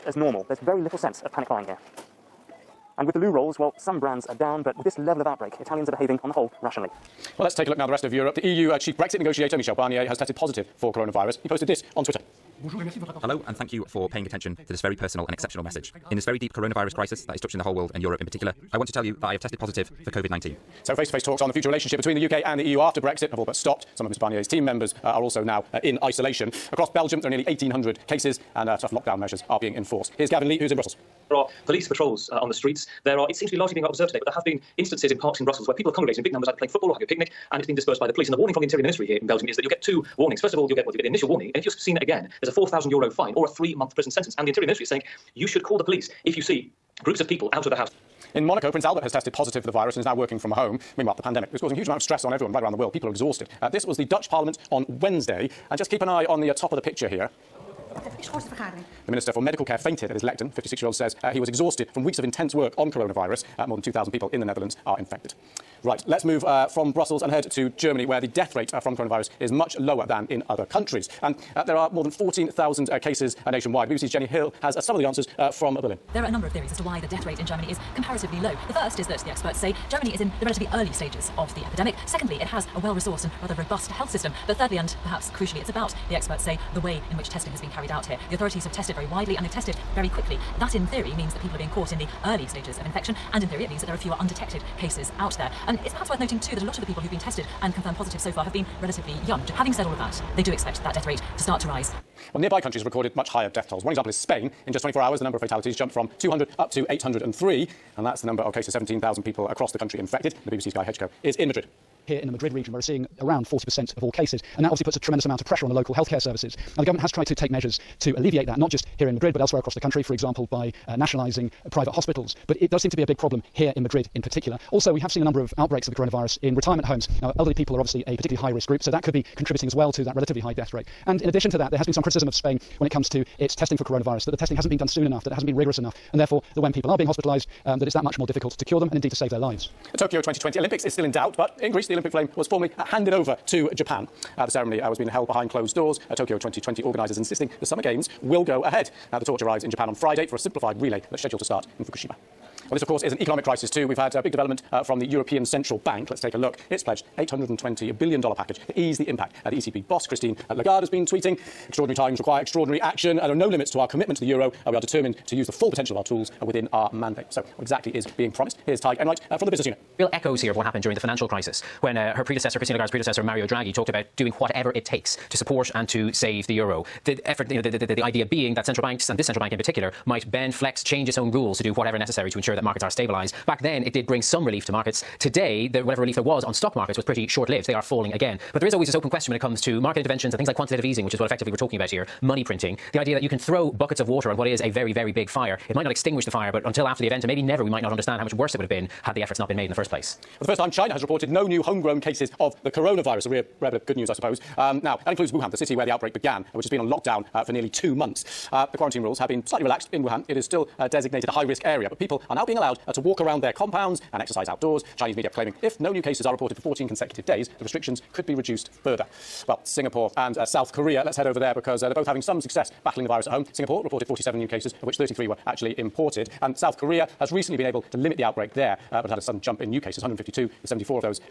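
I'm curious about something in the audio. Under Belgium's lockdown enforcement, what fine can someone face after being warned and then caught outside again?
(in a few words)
4,000 euros.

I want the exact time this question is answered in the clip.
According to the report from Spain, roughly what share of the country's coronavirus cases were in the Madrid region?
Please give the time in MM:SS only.
01:53.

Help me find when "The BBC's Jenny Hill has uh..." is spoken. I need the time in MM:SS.
01:13.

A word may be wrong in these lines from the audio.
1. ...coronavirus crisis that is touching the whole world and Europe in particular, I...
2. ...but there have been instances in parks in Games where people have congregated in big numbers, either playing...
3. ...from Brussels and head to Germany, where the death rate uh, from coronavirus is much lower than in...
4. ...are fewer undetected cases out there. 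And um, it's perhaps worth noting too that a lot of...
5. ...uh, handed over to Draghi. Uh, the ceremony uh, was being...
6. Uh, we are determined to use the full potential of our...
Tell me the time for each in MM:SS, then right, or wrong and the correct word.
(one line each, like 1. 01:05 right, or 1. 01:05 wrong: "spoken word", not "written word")
1. 00:16 right
2. 00:34 wrong: "Brussels", not "Games"
3. 01:06 right
4. 01:33 right
5. 02:22 wrong: "Japan", not "Draghi"
6. 02:44 right.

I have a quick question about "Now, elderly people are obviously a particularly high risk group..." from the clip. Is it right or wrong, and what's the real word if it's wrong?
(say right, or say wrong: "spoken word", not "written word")
right.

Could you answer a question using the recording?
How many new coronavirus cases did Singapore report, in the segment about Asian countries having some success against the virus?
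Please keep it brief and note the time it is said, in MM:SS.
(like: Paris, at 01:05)
47, at 03:44.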